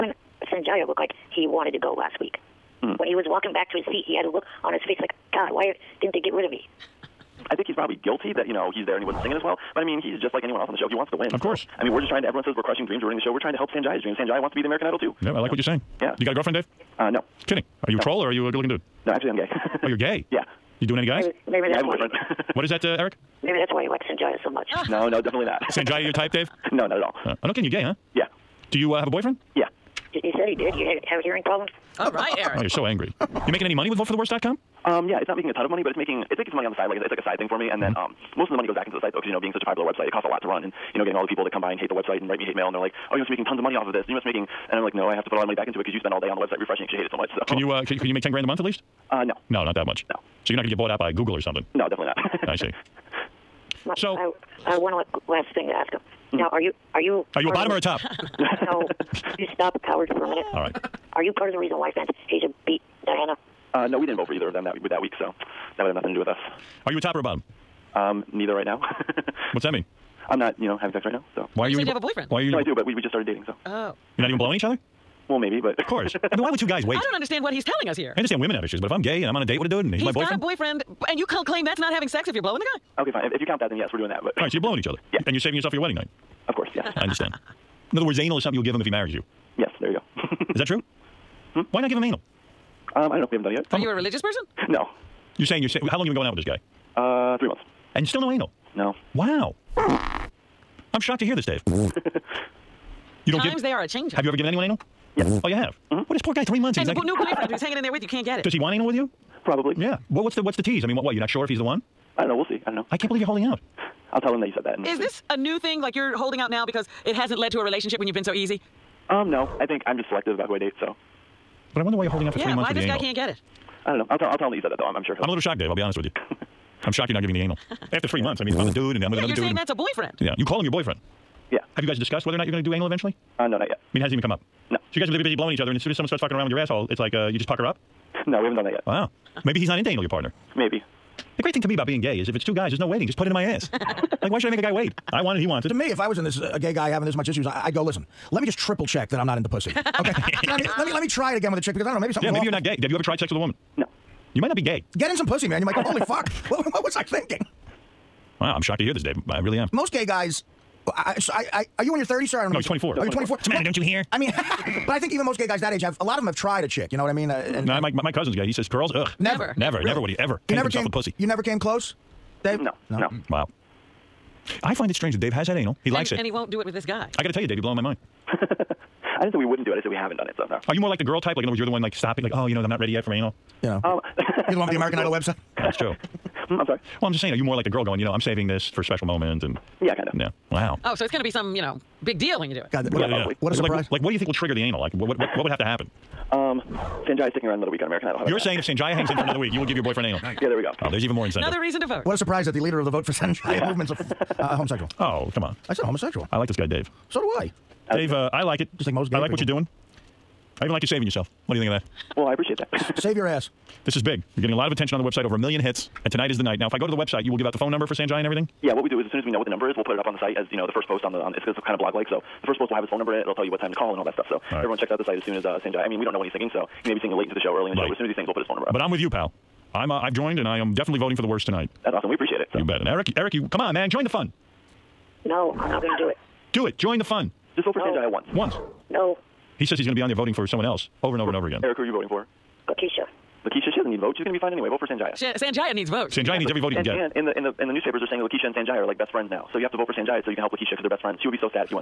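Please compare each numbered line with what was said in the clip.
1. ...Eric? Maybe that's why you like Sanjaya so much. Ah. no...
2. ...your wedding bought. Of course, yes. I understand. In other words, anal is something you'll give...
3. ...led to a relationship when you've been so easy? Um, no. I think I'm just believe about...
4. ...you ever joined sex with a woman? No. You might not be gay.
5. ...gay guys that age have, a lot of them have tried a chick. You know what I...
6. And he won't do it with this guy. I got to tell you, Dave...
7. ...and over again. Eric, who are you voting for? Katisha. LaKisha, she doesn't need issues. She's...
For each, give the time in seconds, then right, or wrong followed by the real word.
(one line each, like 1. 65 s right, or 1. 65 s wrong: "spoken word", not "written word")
1. 22 s right
2. 85 s wrong: "night", not "bought"
3. 117 s wrong: "selective", not "believe"
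4. 152 s wrong: "tried", not "joined"
5. 165 s right
6. 176 s right
7. 241 s wrong: "votes", not "issues".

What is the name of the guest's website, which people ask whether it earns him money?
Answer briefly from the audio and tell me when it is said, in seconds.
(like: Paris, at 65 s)
VoteForTheWorst.com, at 33 s.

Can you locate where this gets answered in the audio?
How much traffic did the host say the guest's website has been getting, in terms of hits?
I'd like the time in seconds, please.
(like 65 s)
215 s.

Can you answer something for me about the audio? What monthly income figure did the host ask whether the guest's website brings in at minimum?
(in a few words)
10 grand.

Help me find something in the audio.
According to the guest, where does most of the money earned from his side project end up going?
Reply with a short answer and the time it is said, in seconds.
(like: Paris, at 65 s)
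Back into the site, at 38 s.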